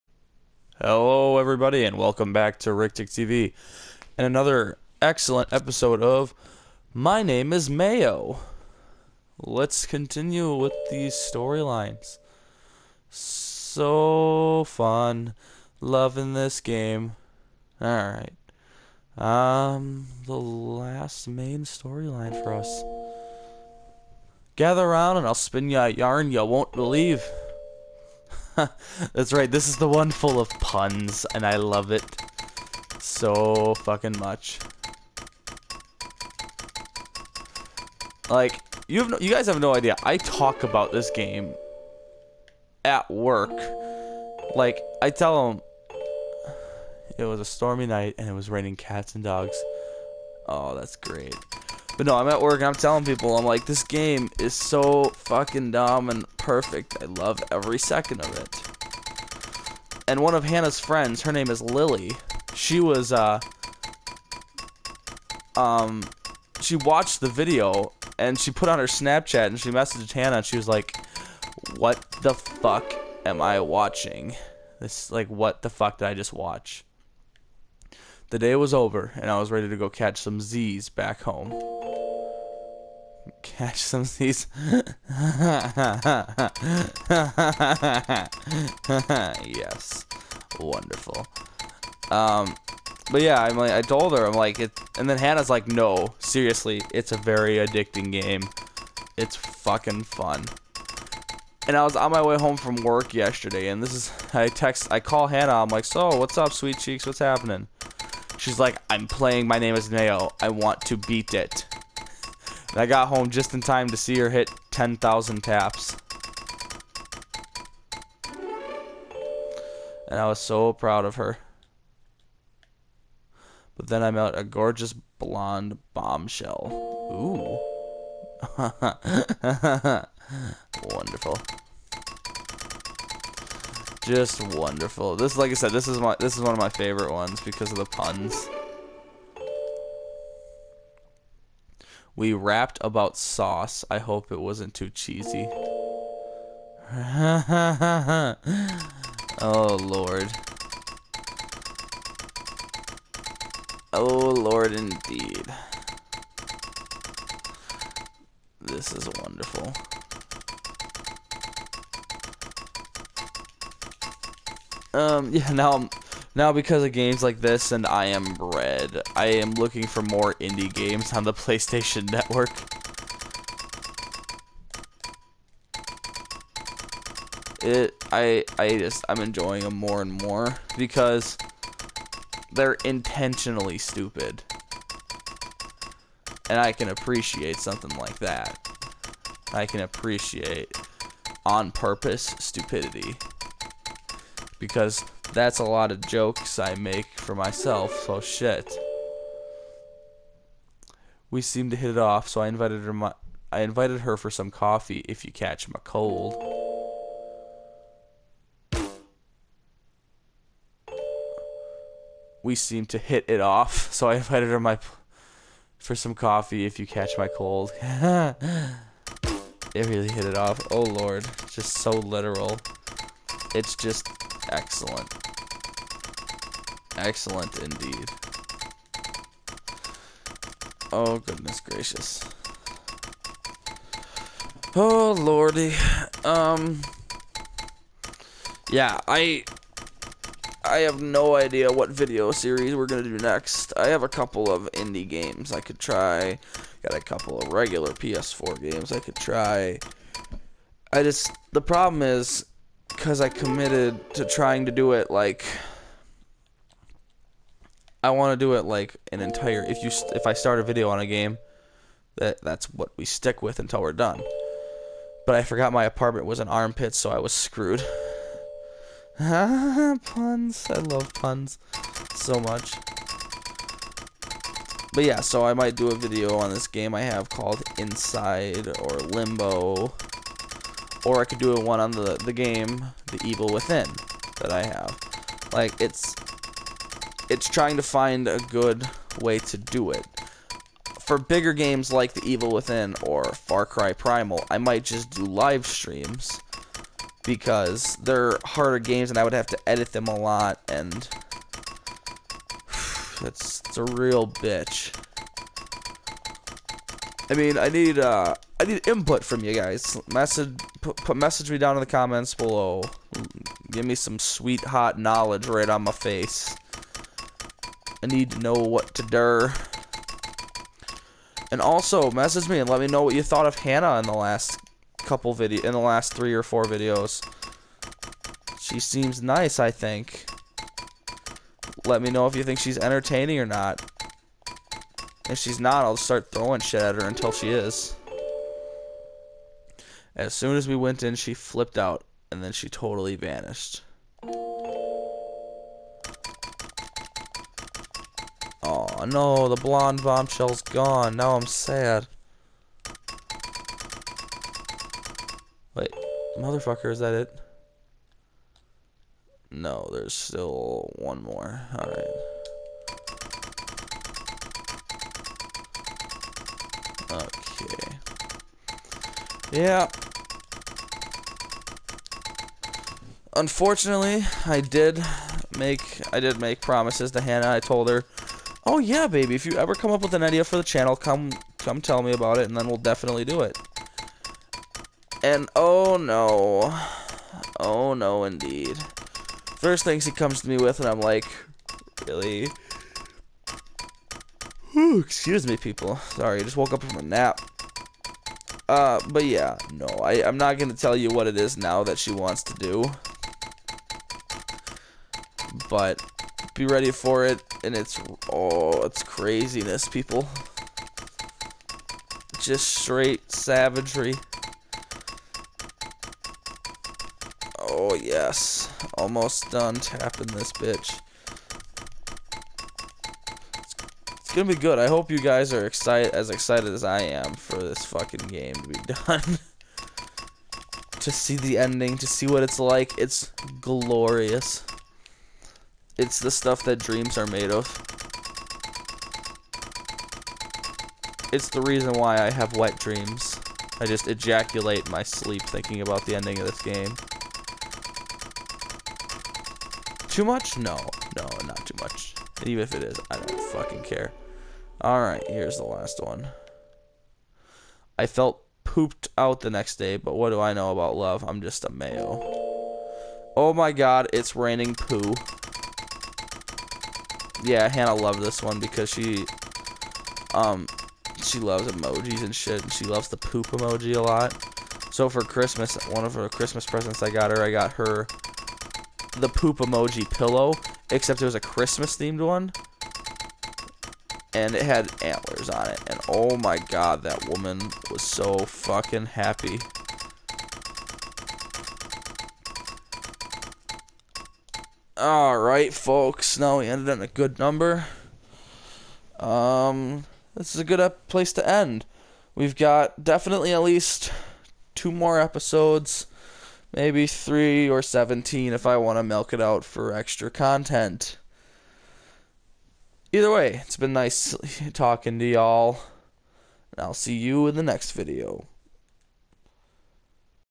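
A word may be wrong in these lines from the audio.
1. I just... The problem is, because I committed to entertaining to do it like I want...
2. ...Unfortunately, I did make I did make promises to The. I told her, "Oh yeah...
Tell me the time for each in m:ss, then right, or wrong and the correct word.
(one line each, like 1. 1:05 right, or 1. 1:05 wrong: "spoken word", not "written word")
1. 4:10 wrong: "trying", not "entertaining"
2. 6:13 wrong: "Hannah", not "The".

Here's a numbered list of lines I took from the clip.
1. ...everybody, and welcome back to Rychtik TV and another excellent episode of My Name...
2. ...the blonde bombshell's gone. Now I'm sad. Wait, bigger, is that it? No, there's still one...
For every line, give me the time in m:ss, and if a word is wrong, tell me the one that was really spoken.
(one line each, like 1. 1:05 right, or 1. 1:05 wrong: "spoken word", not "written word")
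1. 0:01 right
2. 5:49 wrong: "motherfucker", not "bigger".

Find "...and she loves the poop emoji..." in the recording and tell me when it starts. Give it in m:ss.
7:52.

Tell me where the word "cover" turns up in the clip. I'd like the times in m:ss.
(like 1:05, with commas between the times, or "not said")
not said.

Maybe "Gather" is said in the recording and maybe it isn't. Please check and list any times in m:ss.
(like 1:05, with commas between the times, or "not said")
0:24.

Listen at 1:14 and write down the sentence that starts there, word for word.
This, like, what the fuck did I just watch?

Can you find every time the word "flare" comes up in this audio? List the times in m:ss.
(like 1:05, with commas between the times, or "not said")
not said.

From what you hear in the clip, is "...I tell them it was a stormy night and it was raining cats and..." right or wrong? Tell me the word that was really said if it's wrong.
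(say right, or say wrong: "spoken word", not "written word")
right.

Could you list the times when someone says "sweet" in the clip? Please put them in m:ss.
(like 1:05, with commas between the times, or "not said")
1:46, 5:14.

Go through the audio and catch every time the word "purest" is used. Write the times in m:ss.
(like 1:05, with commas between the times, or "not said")
not said.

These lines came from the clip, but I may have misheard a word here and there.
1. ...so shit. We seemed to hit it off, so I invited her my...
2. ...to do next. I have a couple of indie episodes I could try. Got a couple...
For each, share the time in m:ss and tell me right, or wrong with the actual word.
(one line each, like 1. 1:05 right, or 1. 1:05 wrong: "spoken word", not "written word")
1. 3:18 right
2. 4:03 wrong: "games", not "episodes".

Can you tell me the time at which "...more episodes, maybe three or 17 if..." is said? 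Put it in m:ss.
8:24.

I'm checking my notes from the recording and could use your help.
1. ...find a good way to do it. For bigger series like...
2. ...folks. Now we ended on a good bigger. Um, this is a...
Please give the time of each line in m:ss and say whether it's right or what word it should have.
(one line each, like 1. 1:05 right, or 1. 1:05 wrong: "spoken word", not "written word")
1. 4:47 wrong: "games", not "series"
2. 8:15 wrong: "number", not "bigger".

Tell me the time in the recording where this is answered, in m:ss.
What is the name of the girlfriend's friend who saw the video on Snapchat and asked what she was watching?
1:01.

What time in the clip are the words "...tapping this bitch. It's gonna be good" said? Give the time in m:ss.
6:59.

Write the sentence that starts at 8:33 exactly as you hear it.
Either way, it's been nice talking to y'all.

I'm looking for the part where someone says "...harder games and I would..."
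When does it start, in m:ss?
4:58.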